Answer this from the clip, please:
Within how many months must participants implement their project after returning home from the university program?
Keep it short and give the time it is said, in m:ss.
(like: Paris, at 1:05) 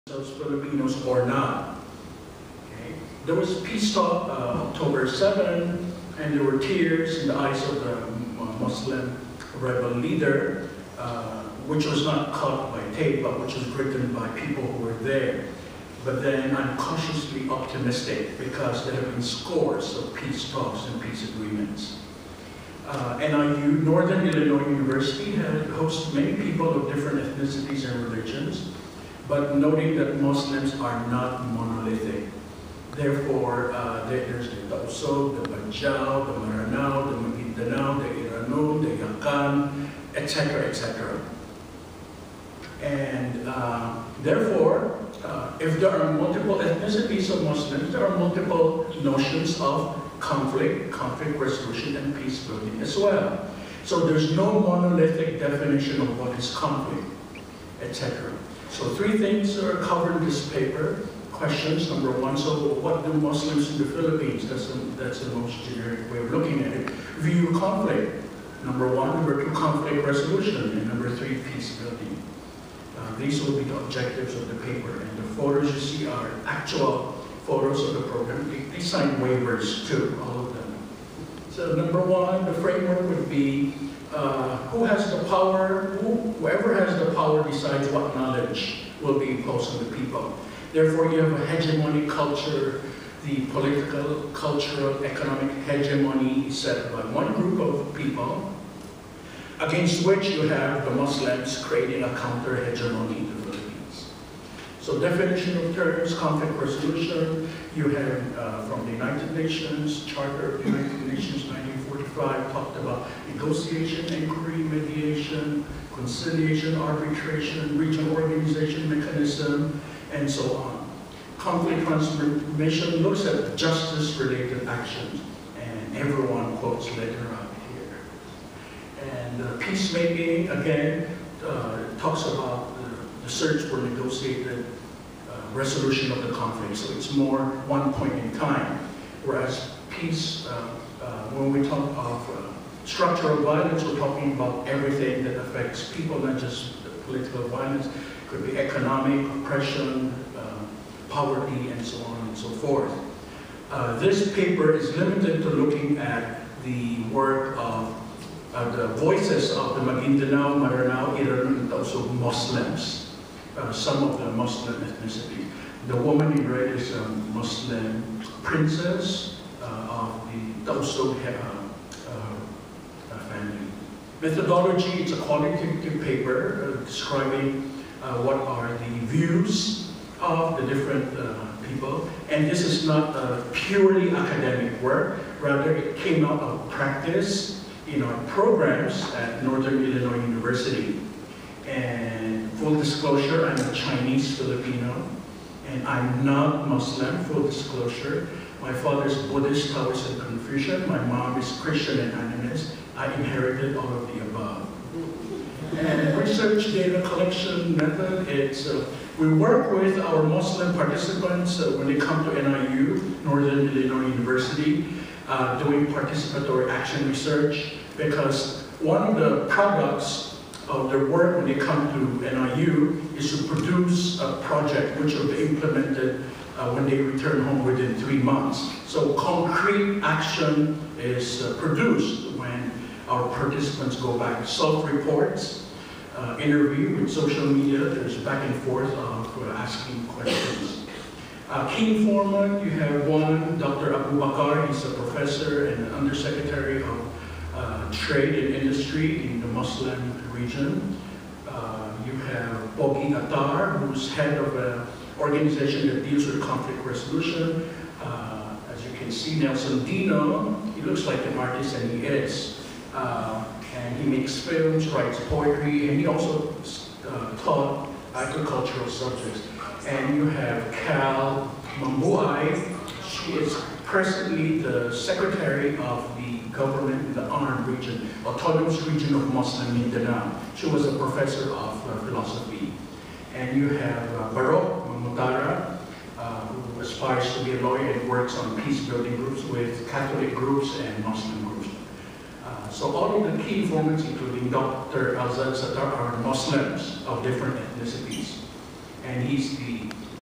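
3, at 3:47.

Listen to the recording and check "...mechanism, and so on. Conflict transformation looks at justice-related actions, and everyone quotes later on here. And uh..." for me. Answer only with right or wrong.
right.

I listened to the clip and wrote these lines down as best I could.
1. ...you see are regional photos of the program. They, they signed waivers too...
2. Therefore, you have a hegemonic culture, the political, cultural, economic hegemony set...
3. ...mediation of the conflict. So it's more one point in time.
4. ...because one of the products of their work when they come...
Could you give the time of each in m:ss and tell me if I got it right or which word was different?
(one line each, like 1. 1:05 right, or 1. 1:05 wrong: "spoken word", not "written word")
1. 1:15 wrong: "actual", not "regional"
2. 1:30 right
3. 2:15 wrong: "resolution", not "mediation"
4. 3:37 right.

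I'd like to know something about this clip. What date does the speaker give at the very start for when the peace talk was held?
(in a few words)
October 7.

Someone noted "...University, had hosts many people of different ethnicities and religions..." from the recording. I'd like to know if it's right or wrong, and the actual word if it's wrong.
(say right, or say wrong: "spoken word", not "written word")
right.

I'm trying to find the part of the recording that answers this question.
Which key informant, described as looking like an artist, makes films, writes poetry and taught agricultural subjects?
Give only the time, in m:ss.
4:19.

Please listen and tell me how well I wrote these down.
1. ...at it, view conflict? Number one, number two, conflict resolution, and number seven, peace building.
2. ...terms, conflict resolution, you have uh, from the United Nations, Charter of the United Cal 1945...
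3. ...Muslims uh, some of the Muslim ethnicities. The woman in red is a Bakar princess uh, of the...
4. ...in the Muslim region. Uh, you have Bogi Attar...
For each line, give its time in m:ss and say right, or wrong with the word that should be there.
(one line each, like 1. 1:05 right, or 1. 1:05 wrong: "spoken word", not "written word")
1. 1:06 wrong: "three", not "seven"
2. 1:45 wrong: "Nations", not "Cal"
3. 2:42 wrong: "Muslim", not "Bakar"
4. 4:09 right.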